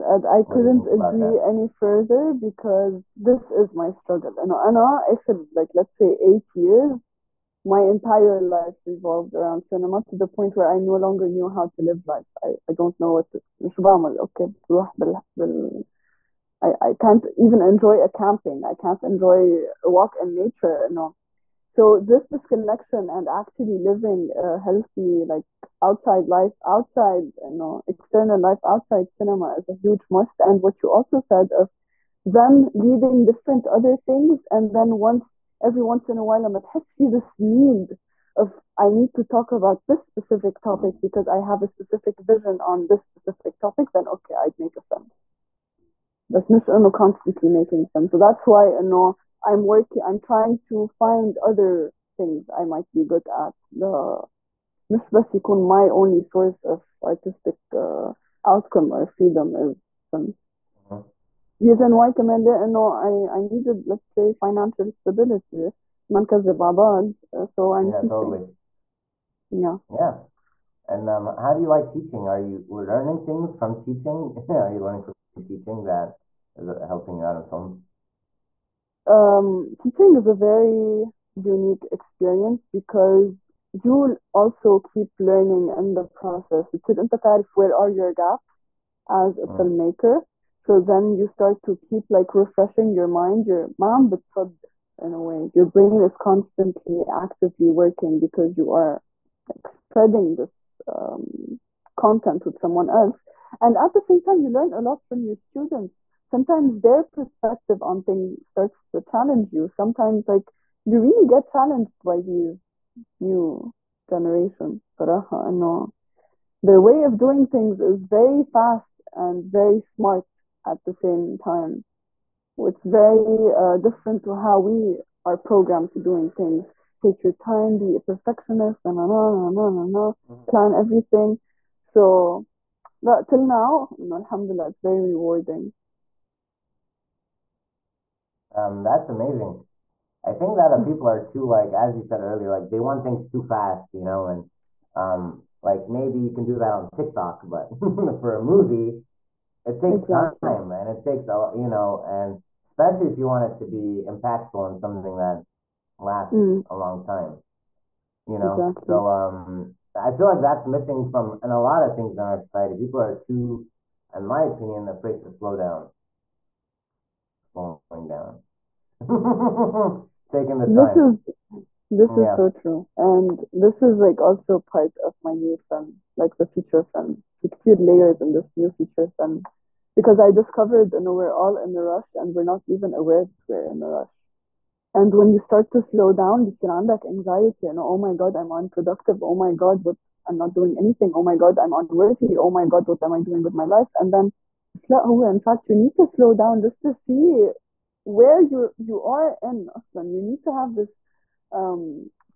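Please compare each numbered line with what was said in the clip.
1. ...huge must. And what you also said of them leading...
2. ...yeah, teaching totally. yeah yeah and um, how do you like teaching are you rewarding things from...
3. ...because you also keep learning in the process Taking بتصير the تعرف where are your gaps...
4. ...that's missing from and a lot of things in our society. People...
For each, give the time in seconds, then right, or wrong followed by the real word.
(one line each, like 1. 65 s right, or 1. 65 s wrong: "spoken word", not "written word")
1. 29 s right
2. 67 s wrong: "learning", not "rewarding"
3. 82 s wrong: "But", not "Taking"
4. 160 s right.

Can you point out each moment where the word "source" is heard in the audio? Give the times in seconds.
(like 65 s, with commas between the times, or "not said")
56 s.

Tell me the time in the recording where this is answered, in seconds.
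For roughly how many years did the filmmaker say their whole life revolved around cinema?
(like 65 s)
6 s.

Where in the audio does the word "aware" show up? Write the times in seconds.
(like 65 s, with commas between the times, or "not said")
182 s.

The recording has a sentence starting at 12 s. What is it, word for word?
I, I don't know what to, okay.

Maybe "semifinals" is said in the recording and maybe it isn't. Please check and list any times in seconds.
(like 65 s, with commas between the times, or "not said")
not said.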